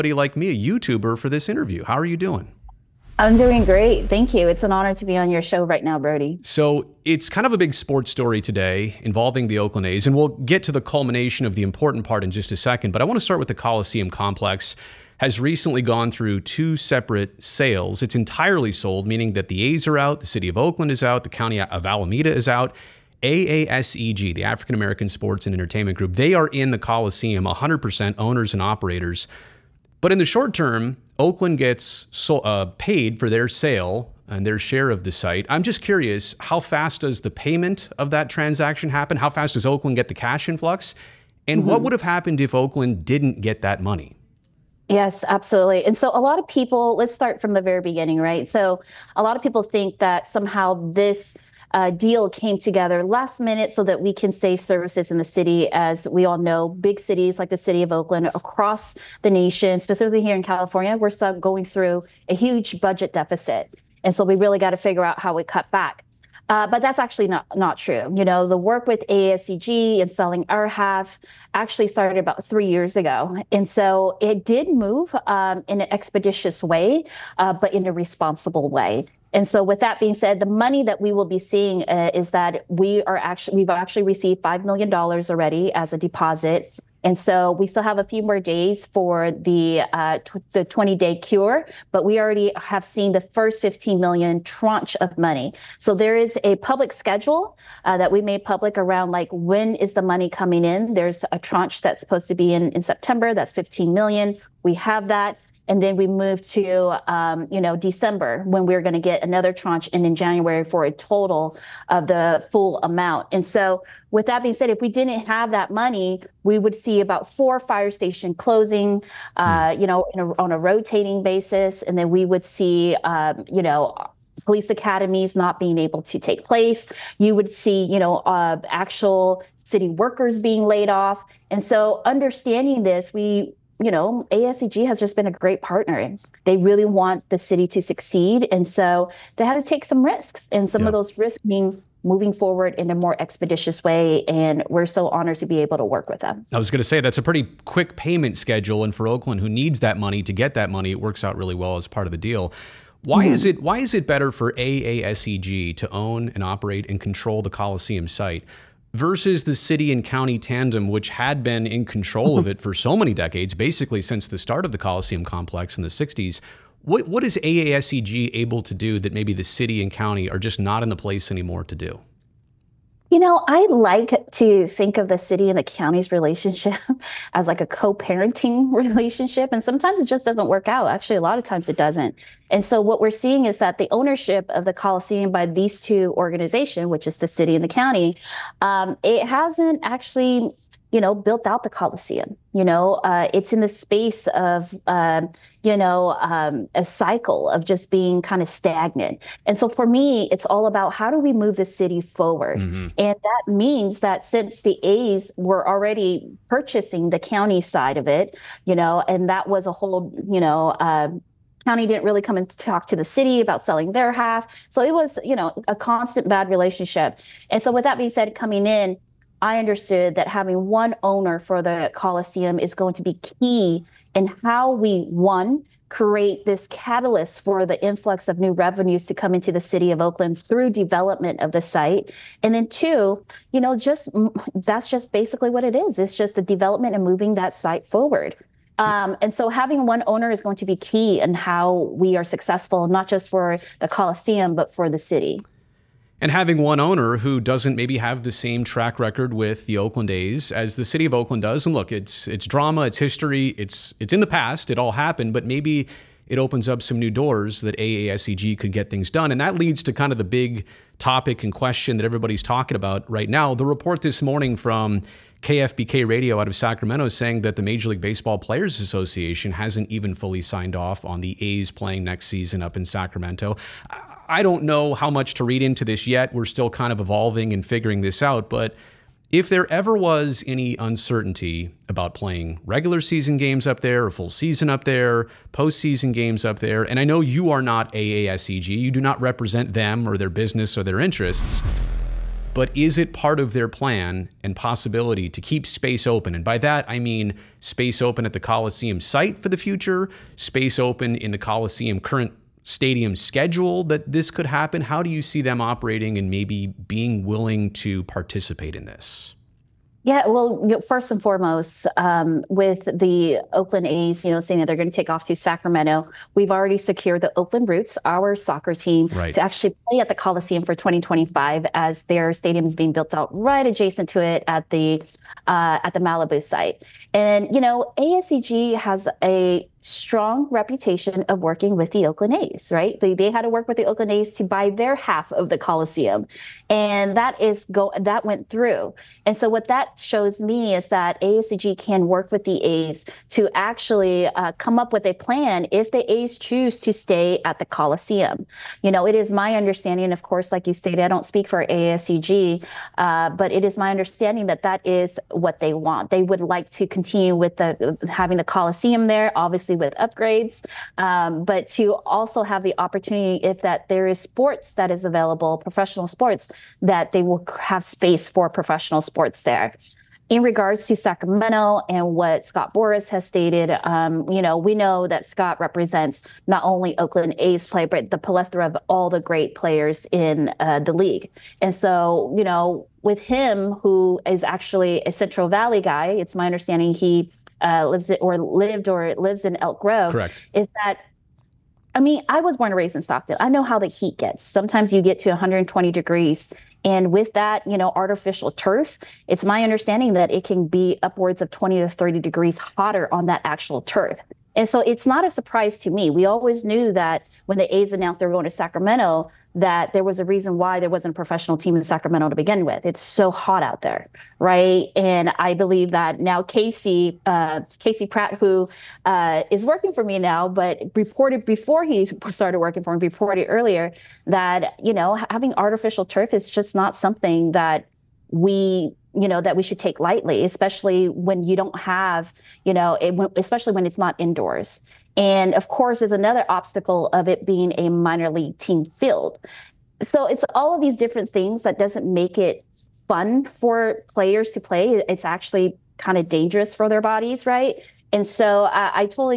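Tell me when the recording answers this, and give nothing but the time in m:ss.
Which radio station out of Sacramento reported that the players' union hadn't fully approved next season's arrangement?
4:25.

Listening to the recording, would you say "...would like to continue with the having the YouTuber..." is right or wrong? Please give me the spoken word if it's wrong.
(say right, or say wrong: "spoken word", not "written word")
wrong: "Coliseum", not "YouTuber".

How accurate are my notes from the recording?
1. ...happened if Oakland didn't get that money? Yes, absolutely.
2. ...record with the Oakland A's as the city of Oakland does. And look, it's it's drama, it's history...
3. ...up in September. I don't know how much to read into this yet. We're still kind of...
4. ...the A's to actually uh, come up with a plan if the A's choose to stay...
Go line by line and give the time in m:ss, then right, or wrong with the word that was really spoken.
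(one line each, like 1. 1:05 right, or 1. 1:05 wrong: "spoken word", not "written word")
1. 0:42 right
2. 4:08 right
3. 4:32 wrong: "Sacramento", not "September"
4. 5:42 right.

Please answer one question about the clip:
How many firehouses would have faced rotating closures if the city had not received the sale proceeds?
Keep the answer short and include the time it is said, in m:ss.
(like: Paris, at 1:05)
4, at 1:57.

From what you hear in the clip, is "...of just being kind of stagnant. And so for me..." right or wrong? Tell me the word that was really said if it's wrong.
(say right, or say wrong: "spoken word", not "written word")
right.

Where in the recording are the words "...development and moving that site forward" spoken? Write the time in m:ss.
3:56.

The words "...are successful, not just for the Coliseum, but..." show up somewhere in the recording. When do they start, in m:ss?
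4:02.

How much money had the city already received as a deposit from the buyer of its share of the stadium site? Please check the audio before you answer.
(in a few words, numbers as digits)
$5 million.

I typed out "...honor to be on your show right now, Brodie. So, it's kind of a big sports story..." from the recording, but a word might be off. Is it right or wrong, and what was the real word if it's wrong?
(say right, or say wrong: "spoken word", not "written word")
right.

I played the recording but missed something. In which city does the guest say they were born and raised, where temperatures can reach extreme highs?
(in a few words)
Stockton.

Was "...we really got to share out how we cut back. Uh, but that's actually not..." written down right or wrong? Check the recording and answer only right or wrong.
wrong.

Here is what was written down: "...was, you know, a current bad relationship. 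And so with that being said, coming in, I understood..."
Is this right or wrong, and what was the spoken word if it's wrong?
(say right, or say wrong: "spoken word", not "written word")
wrong: "constant", not "current".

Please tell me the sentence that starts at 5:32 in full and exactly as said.
They, they had to work with the Oakland A's to buy their half of the Coliseum.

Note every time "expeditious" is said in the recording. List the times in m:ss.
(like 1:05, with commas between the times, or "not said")
1:15, 2:23.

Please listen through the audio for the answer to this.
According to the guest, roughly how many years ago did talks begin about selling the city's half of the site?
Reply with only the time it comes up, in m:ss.
1:12.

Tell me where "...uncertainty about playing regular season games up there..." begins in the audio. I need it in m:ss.
4:40.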